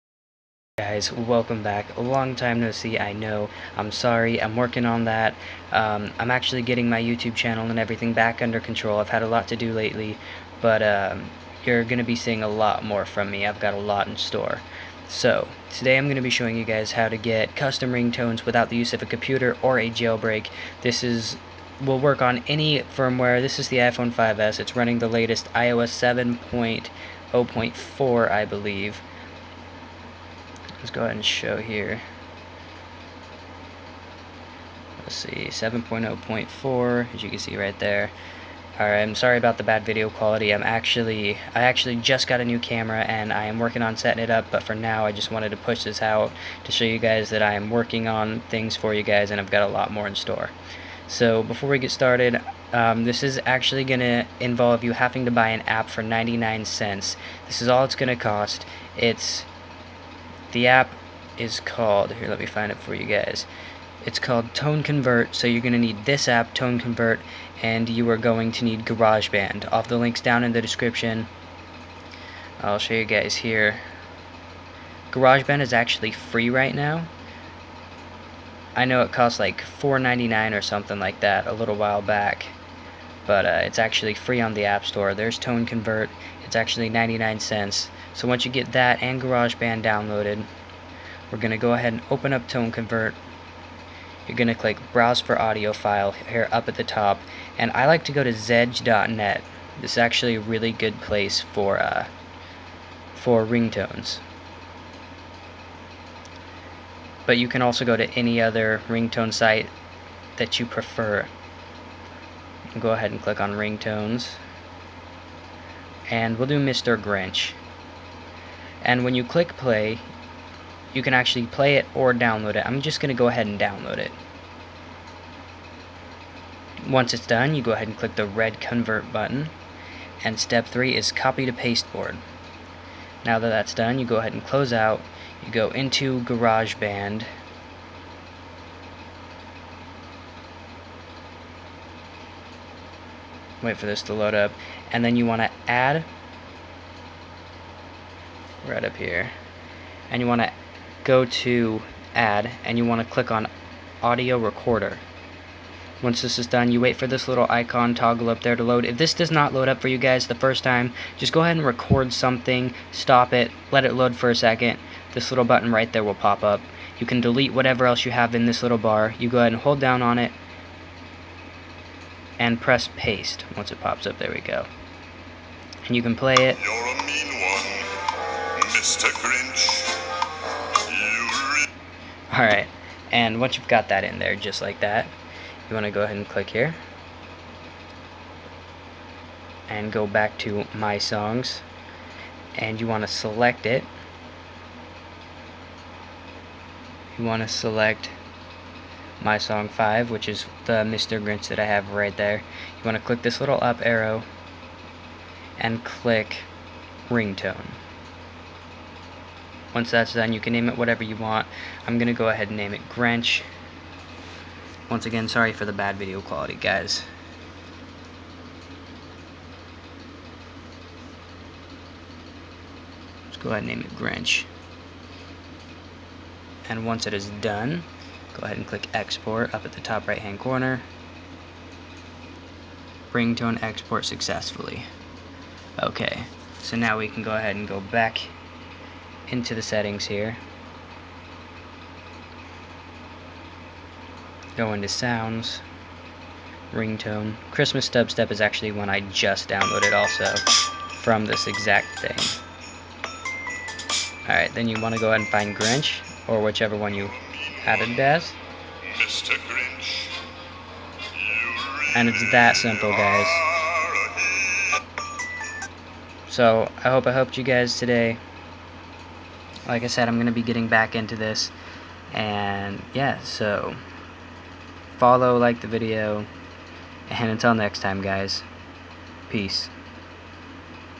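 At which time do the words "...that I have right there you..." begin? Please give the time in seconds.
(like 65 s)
201 s.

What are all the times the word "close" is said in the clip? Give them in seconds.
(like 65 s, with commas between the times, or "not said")
134 s.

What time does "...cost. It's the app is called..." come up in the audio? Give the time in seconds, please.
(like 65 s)
58 s.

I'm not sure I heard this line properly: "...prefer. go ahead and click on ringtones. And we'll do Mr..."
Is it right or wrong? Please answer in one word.
right.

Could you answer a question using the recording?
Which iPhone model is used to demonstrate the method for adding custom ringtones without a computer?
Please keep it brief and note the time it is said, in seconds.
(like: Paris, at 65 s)
iPhone 5S, at 23 s.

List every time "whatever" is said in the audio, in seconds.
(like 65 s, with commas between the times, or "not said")
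167 s, 210 s.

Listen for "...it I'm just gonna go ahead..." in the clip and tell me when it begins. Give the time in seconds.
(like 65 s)
122 s.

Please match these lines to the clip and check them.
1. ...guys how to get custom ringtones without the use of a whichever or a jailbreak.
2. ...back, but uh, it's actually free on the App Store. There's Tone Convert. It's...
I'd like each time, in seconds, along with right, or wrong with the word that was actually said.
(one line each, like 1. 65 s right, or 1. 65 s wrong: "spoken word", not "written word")
1. 16 s wrong: "computer", not "whichever"
2. 82 s right.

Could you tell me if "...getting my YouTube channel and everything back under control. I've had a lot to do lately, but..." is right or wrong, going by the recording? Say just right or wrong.
right.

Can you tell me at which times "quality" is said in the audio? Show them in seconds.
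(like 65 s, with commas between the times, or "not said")
40 s, 216 s.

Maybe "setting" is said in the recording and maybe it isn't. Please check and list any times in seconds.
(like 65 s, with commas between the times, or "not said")
43 s, 239 s.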